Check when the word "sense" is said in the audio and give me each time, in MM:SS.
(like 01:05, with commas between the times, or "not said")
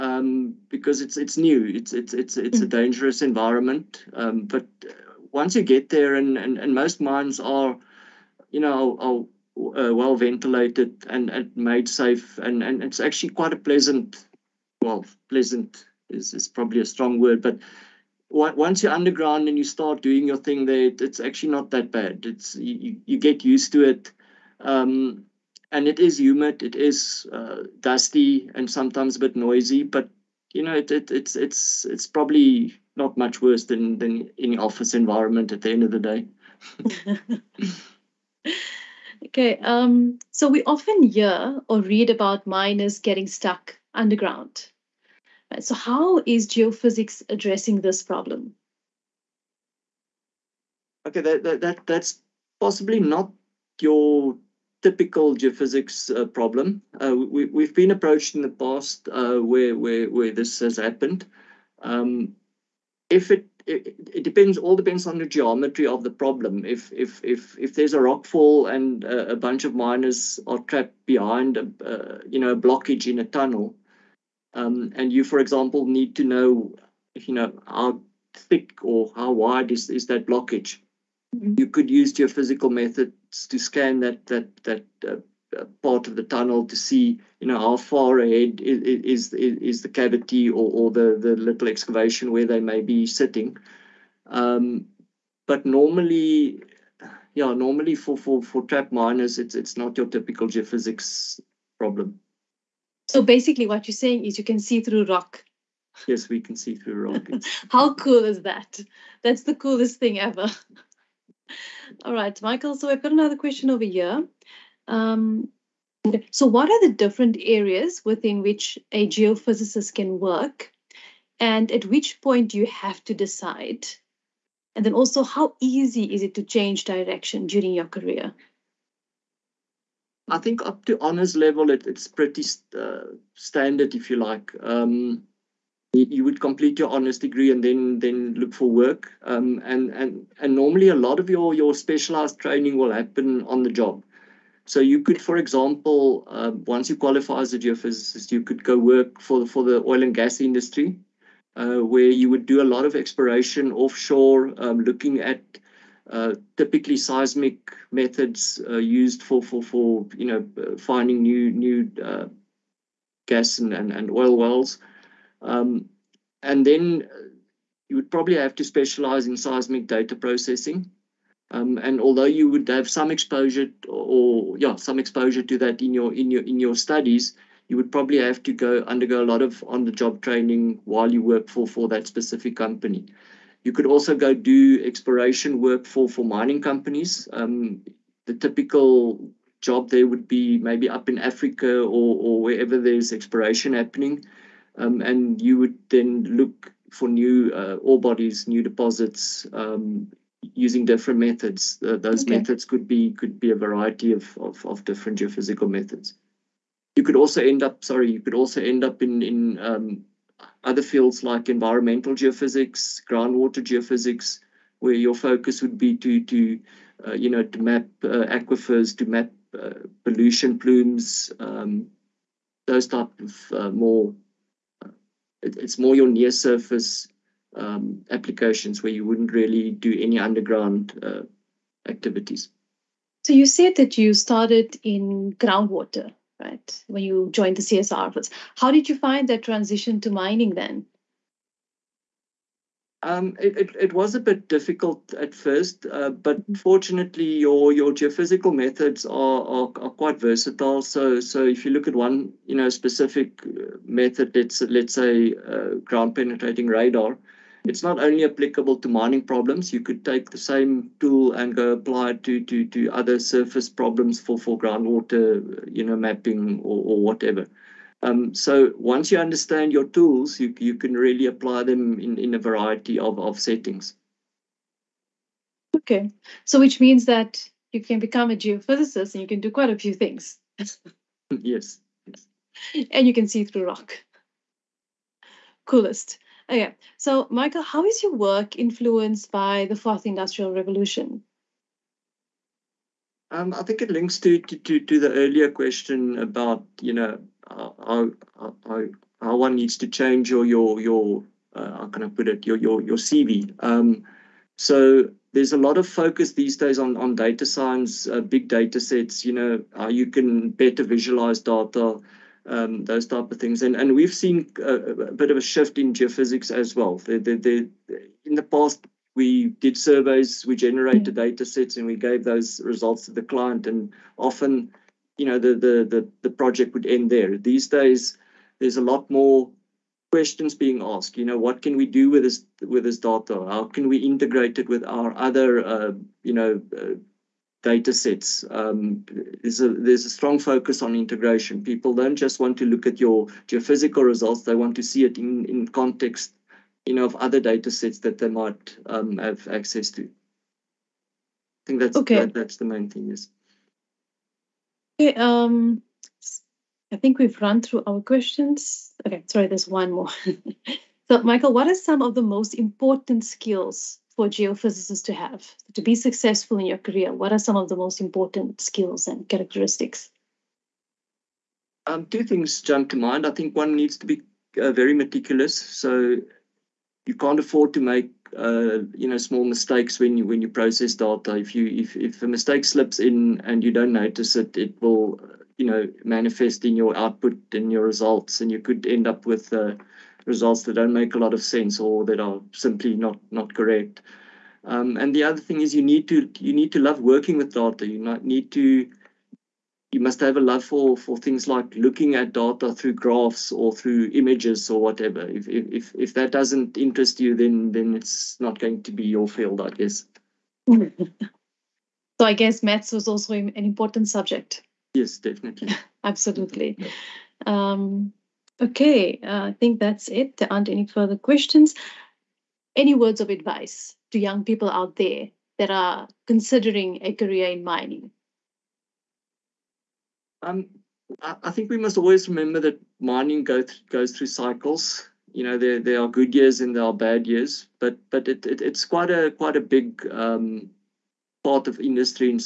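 06:31.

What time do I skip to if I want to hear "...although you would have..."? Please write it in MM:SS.
02:51.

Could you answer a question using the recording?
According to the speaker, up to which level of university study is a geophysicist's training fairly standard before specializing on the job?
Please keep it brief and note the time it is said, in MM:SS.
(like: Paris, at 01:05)
Honors level, at 02:10.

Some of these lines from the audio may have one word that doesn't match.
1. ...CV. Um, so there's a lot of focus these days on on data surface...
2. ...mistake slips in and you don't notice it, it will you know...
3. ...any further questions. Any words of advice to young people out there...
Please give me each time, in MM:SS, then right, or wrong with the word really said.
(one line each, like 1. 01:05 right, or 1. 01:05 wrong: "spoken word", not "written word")
1. 05:02 wrong: "science", not "surface"
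2. 06:22 right
3. 07:00 right.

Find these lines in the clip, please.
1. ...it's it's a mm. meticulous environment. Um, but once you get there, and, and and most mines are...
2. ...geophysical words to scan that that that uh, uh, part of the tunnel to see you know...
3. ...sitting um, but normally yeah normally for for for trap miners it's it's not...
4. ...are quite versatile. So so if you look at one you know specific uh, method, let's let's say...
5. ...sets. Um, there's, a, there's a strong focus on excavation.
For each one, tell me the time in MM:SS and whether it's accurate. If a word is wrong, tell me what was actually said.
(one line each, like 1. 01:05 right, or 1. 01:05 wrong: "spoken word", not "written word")
1. 00:02 wrong: "dangerous", not "meticulous"
2. 01:22 wrong: "methods", not "words"
3. 01:33 right
4. 04:09 right
5. 05:37 wrong: "integration", not "excavation".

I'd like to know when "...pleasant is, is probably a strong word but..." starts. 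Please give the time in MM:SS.
00:15.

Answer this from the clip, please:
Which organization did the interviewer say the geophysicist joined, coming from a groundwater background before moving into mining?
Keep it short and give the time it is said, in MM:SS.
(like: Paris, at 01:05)
CSIR, at 03:57.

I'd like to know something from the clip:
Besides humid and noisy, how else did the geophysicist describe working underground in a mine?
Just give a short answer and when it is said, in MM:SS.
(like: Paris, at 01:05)
Dusty, at 00:27.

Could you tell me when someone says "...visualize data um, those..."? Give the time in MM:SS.
05:10.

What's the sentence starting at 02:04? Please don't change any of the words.
And then also, how easy is it to change direction during your career?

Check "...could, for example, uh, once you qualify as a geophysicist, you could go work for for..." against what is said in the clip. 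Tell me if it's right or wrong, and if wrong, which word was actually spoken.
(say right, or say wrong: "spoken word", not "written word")
right.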